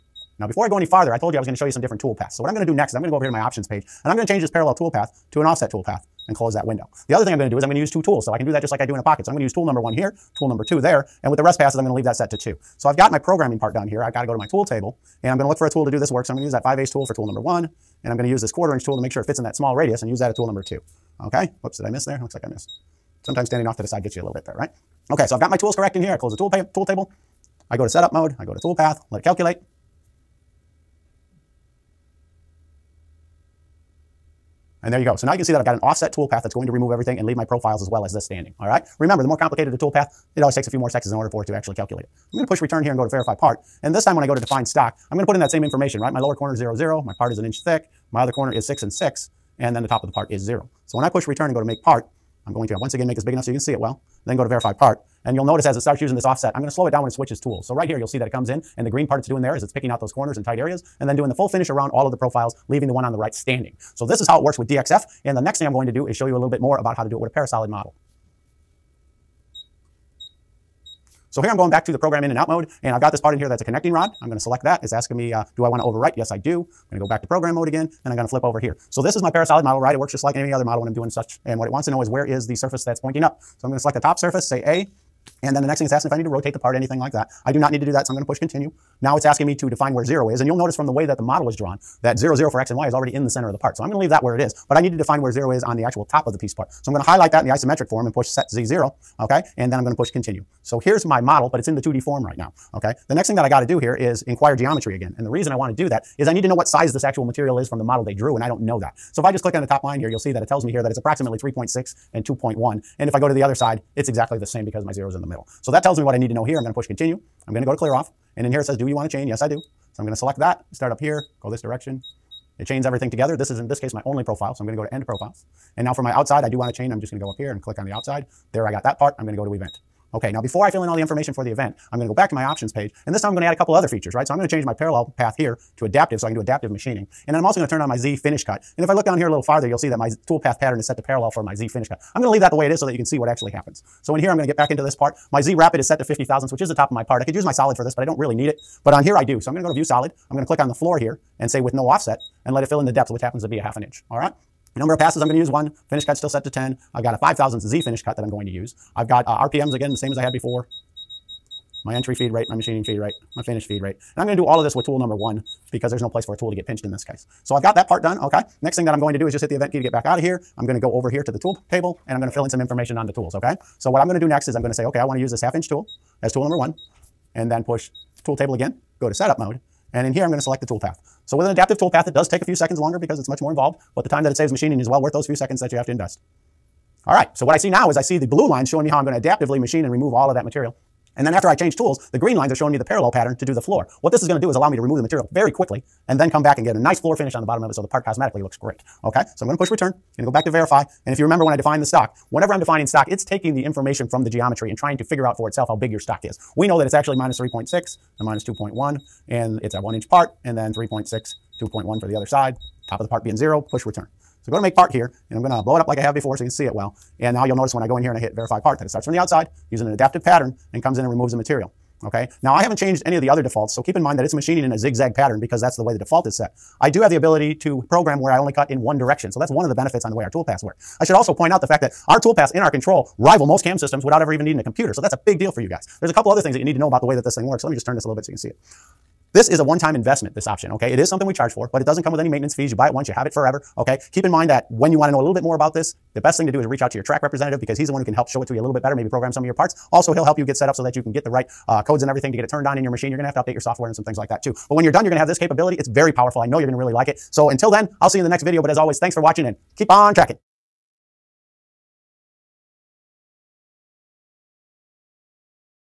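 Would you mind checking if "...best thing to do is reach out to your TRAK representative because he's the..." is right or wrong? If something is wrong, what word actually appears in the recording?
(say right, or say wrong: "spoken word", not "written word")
right.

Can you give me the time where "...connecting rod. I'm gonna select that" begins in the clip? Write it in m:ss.
1:13.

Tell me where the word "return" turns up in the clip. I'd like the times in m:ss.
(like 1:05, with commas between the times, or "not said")
0:42, 0:51, 3:19, 3:33.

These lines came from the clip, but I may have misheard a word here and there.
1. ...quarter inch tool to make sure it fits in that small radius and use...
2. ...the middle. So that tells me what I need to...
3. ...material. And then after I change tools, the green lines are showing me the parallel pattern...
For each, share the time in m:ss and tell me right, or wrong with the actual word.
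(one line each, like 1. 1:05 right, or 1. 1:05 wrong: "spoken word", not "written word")
1. 0:18 right
2. 1:55 right
3. 3:10 right.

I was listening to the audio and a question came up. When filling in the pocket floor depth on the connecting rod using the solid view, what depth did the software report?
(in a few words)
half an inch.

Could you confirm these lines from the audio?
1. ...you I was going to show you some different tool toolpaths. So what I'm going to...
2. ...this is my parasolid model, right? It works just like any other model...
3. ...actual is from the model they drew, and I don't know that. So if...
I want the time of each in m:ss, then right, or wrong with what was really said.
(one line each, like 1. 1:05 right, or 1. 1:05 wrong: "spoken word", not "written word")
1. 0:01 wrong: "paths", not "toolpaths"
2. 1:19 right
3. 1:47 wrong: "material", not "actual".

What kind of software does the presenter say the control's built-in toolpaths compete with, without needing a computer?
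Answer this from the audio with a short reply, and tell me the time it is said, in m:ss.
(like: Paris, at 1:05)
CAM systems, at 3:53.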